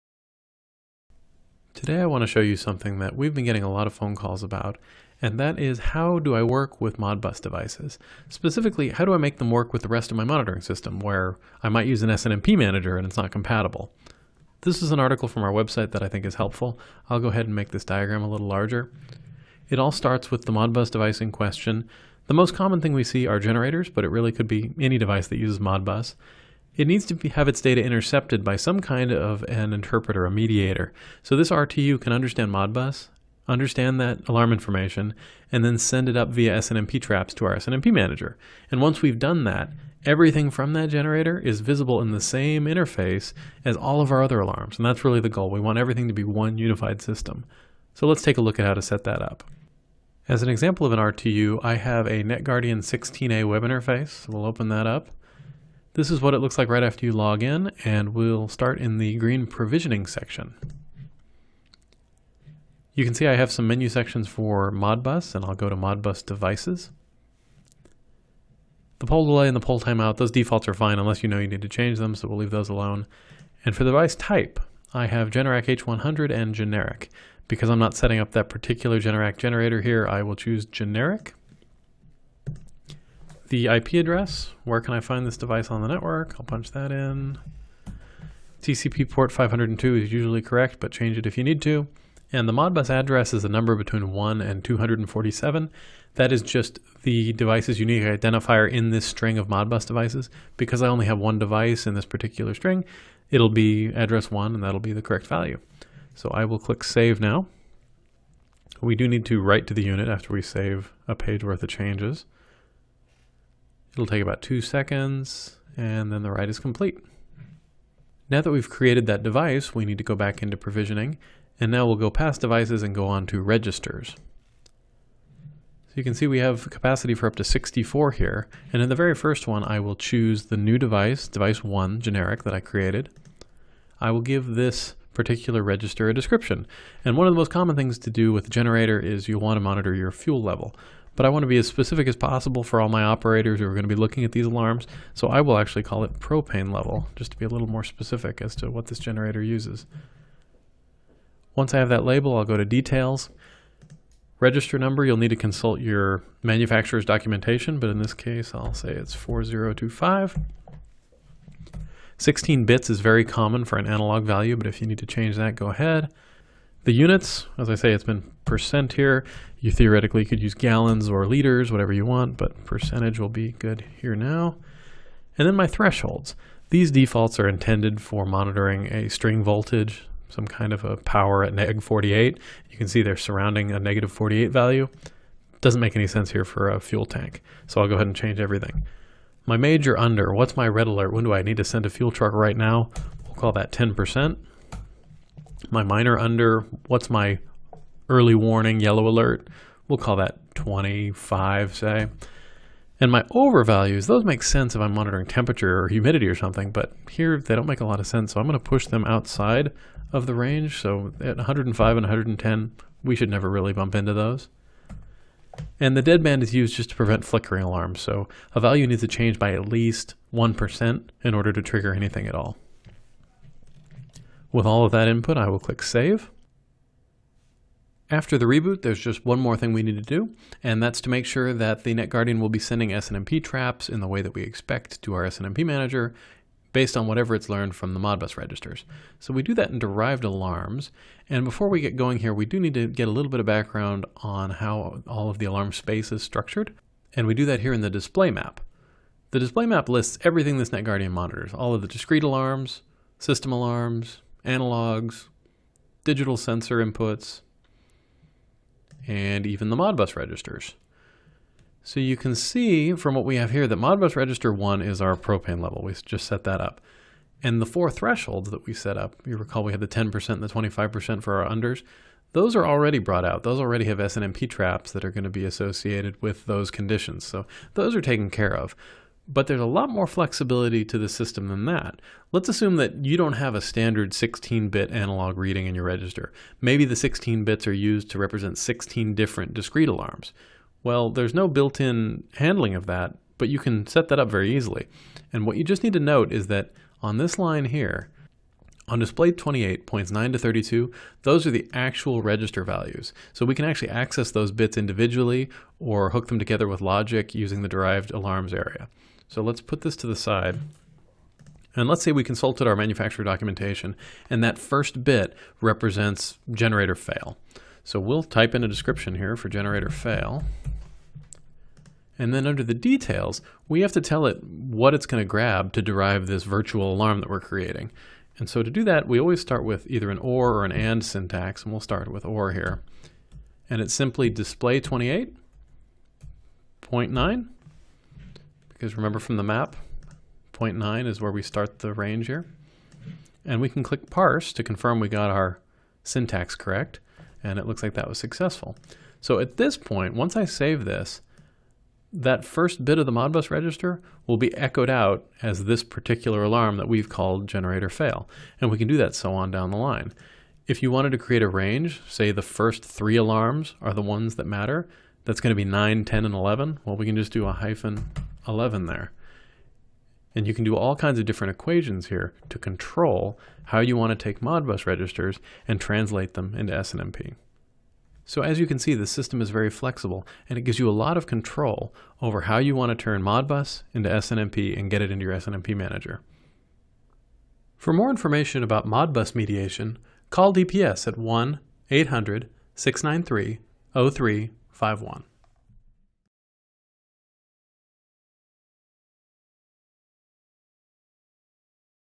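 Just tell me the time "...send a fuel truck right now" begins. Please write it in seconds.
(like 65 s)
191 s.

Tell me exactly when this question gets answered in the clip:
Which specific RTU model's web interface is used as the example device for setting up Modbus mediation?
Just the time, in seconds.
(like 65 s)
52 s.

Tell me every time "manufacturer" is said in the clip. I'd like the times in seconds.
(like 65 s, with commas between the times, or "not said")
156 s, 312 s.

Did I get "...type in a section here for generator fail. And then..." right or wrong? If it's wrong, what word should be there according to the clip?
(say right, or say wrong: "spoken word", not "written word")
wrong: "description", not "section".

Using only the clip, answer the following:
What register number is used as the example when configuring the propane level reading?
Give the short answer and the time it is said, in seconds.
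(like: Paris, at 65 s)
4025, at 159 s.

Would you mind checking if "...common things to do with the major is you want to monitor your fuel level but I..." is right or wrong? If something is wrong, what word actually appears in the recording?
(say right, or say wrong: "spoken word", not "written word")
wrong: "generator", not "major".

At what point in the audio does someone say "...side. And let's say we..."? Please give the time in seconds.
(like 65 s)
310 s.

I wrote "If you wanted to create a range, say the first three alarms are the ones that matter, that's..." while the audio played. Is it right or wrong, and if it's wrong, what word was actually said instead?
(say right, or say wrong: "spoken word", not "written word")
right.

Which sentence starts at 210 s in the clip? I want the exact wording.
So at 105 and 110, we should never really bump into those.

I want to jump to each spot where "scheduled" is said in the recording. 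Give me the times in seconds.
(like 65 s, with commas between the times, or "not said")
not said.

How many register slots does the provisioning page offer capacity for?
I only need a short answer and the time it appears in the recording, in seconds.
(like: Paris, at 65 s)
64, at 127 s.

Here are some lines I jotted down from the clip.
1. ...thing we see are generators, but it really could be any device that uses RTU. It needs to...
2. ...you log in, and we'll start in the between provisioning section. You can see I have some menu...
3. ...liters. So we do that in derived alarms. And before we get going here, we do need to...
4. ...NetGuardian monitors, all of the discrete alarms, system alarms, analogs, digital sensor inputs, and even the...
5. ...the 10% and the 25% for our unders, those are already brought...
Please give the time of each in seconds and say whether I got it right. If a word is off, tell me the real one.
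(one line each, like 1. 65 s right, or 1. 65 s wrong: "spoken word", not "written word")
1. 22 s wrong: "Modbus", not "RTU"
2. 57 s wrong: "green", not "between"
3. 238 s wrong: "registers", not "liters"
4. 250 s right
5. 269 s right.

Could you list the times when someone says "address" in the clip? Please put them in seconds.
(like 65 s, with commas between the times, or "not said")
83 s, 92 s, 103 s.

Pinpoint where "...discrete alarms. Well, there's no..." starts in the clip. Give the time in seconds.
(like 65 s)
289 s.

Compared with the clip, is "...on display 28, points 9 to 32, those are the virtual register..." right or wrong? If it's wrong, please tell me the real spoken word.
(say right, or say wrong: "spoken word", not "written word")
wrong: "actual", not "virtual".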